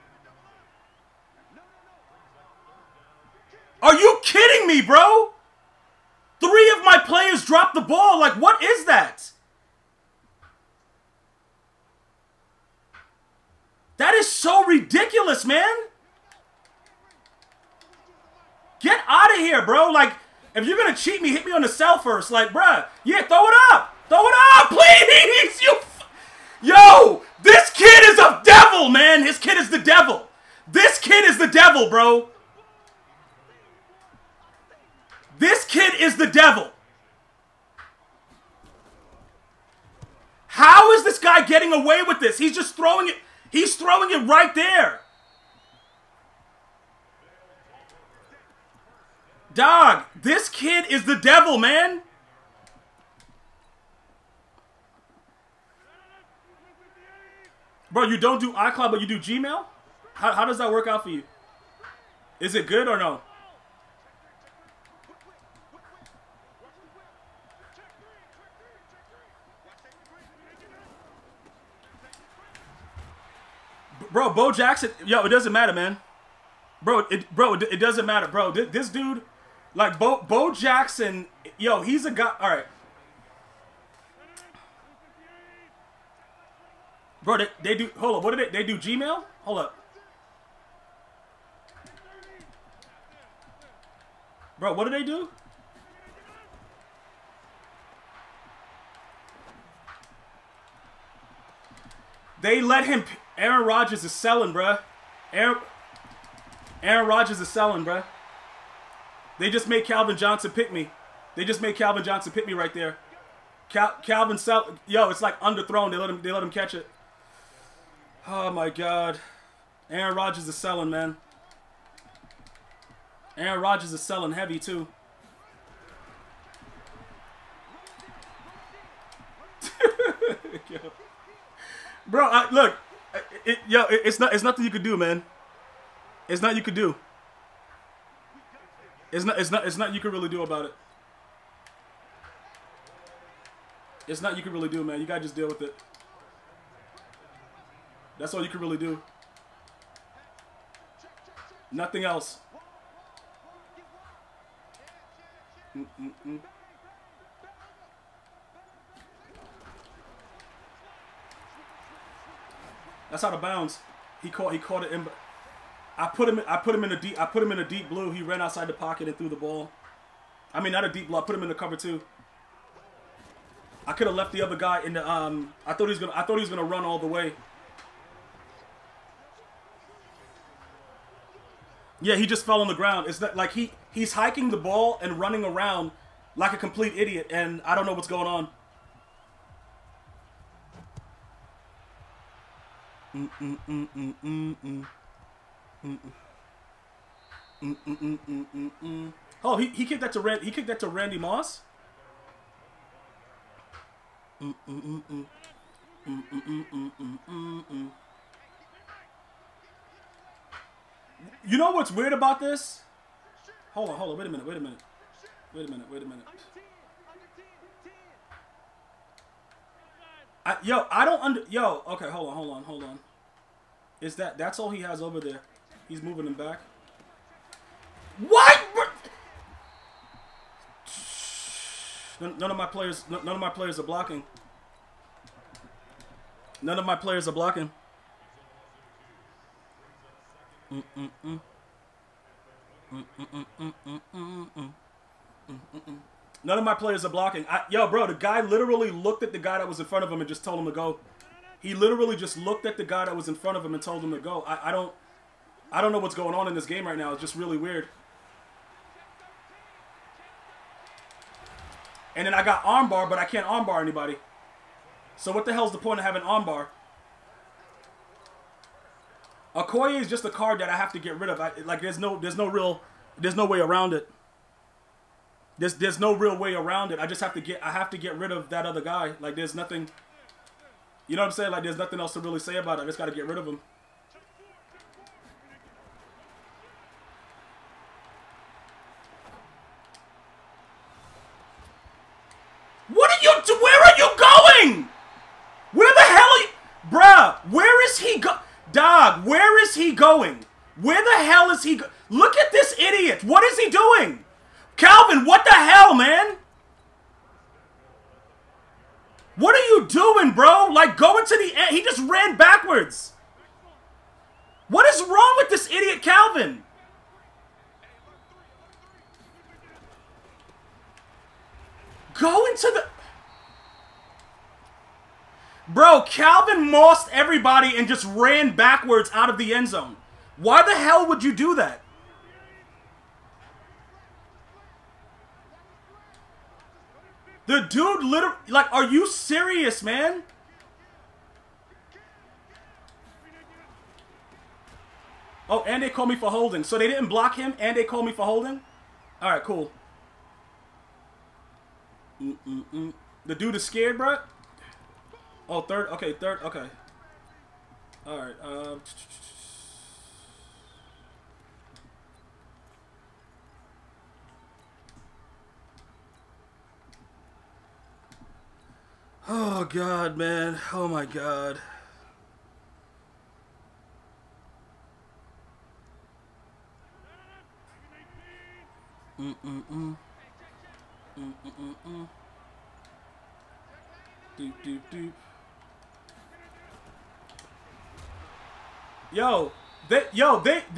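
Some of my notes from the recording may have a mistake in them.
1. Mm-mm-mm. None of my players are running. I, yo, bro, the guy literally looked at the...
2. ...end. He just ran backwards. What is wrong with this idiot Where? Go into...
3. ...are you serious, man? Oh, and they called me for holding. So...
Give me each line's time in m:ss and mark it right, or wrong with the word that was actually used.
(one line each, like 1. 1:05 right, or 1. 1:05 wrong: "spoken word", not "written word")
1. 4:05 wrong: "blocking", not "running"
2. 5:11 wrong: "Calvin", not "Where"
3. 5:38 right.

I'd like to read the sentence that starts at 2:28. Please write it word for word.
That's all you could really do.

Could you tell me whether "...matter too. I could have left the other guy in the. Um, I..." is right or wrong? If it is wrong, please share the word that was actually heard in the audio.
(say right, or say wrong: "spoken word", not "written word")
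wrong: "cover", not "matter".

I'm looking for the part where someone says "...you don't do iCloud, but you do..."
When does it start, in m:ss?
0:58.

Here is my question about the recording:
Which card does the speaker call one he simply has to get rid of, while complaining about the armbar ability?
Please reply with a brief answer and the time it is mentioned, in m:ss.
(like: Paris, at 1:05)
Okoye, at 4:29.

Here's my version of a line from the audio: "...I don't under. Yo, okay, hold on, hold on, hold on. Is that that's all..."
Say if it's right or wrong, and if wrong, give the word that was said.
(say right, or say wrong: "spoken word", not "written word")
right.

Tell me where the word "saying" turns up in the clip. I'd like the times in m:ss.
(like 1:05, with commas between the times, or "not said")
4:41.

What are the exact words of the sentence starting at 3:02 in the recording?
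Yeah, he just fell on the ground.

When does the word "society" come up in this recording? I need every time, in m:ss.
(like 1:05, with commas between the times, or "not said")
not said.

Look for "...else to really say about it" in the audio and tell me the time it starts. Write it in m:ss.
4:42.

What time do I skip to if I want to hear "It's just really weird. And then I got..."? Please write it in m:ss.
4:17.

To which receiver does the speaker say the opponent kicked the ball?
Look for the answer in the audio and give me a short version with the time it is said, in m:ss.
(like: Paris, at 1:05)
Randy Moss, at 3:20.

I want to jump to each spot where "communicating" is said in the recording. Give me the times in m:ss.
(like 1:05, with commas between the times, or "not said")
not said.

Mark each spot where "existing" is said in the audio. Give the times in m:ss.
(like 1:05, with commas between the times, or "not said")
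not said.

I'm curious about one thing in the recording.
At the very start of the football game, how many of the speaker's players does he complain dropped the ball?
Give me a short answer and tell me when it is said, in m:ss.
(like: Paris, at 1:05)
3, at 0:06.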